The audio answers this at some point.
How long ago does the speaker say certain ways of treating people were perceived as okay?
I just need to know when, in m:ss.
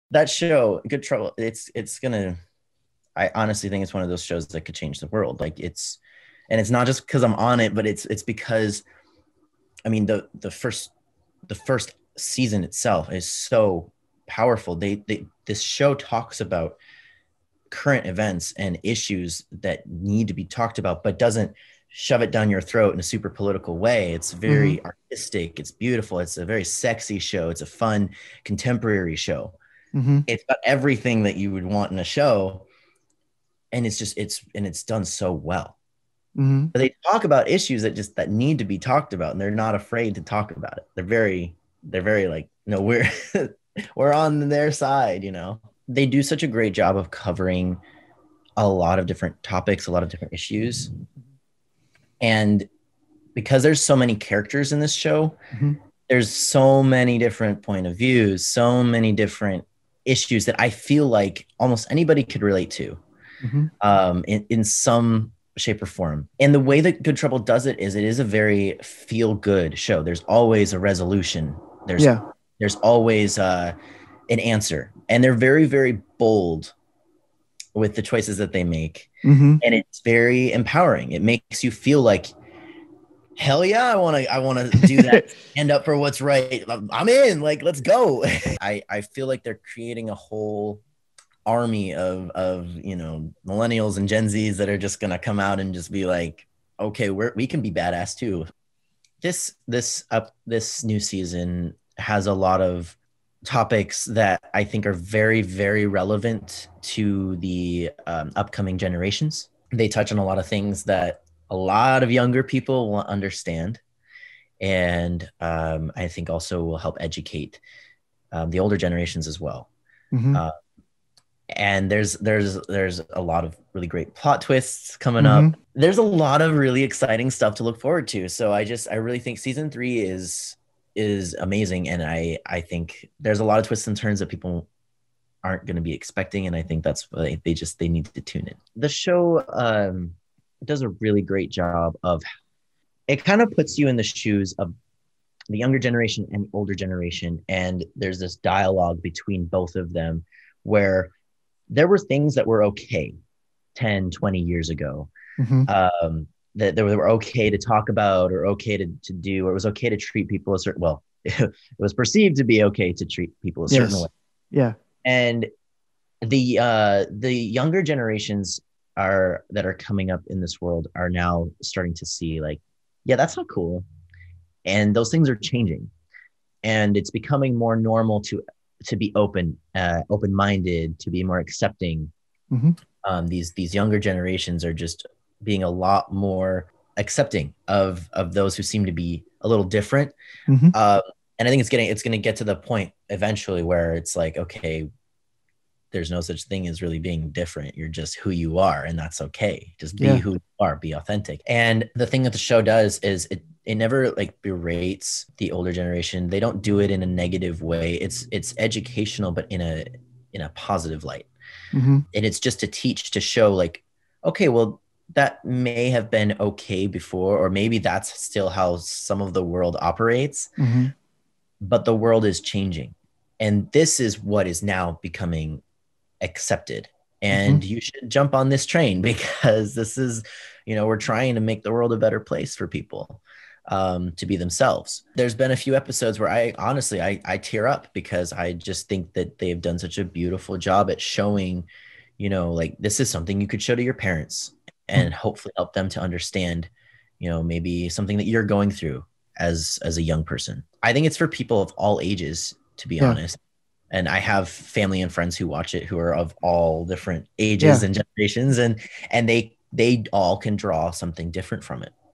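2:33.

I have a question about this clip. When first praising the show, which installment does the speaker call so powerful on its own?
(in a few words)
first season.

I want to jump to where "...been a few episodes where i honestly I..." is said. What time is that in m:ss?
3:55.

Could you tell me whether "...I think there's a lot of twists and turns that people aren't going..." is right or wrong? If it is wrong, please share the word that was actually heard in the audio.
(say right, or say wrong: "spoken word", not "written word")
right.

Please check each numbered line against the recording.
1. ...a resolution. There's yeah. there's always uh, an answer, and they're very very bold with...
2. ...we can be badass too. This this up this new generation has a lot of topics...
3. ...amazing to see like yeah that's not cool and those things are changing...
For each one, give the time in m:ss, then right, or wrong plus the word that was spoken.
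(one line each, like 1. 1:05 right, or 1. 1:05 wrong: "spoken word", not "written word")
1. 1:10 right
2. 1:37 wrong: "season", not "generation"
3. 2:51 wrong: "starting", not "amazing".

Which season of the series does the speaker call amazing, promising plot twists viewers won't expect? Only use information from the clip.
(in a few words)
season 3.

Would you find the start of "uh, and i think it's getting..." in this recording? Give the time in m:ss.
3:10.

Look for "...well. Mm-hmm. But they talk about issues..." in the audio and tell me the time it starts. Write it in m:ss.
0:35.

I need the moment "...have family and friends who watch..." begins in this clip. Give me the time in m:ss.
4:14.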